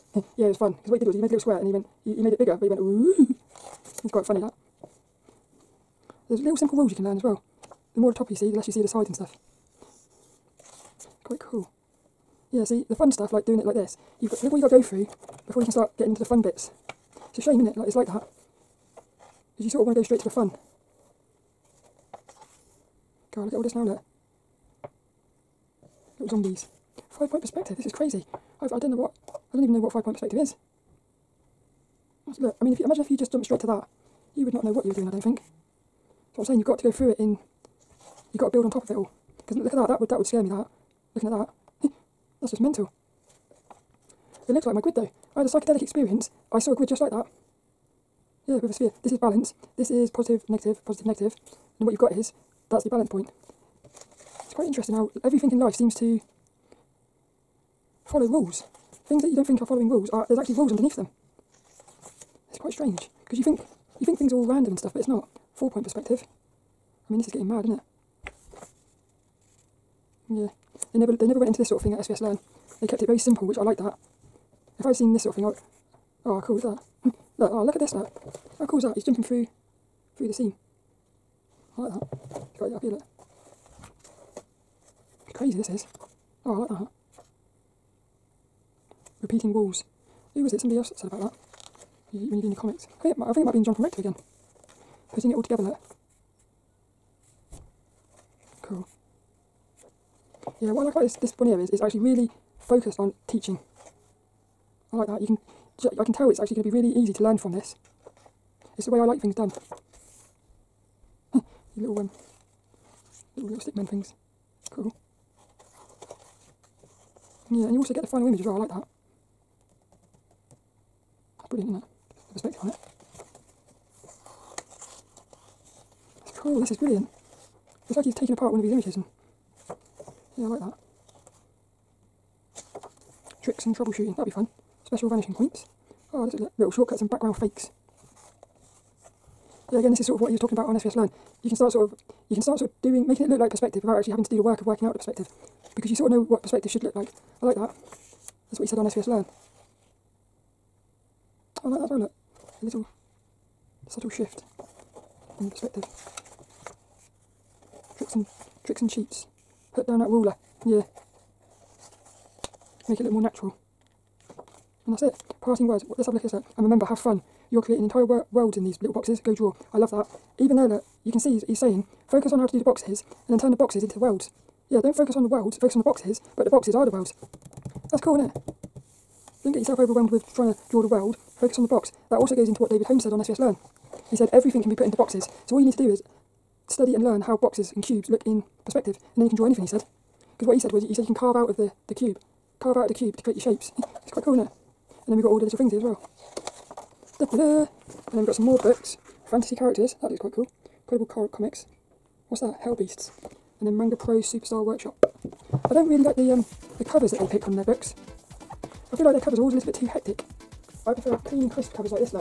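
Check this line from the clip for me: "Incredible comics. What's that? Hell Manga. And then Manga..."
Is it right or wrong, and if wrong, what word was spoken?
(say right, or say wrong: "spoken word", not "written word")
wrong: "Beasts", not "Manga".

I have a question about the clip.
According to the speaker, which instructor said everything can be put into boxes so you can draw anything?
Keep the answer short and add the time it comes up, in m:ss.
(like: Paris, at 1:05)
David Hohn, at 3:02.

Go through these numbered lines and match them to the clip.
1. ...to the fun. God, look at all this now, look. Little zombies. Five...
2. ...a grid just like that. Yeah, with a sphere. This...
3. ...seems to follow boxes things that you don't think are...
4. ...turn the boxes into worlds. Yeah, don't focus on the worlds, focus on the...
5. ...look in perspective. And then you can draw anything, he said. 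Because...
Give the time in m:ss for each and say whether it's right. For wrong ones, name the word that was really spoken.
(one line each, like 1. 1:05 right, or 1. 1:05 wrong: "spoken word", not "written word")
1. 0:20 right
2. 0:46 right
3. 0:55 wrong: "rules", not "boxes"
4. 2:53 right
5. 3:08 right.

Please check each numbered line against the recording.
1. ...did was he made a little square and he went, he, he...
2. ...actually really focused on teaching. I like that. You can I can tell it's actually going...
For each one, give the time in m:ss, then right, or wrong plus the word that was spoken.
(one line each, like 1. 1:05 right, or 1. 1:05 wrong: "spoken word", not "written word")
1. 0:00 right
2. 1:41 right.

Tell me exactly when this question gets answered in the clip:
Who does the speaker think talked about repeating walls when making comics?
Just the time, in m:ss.
1:33.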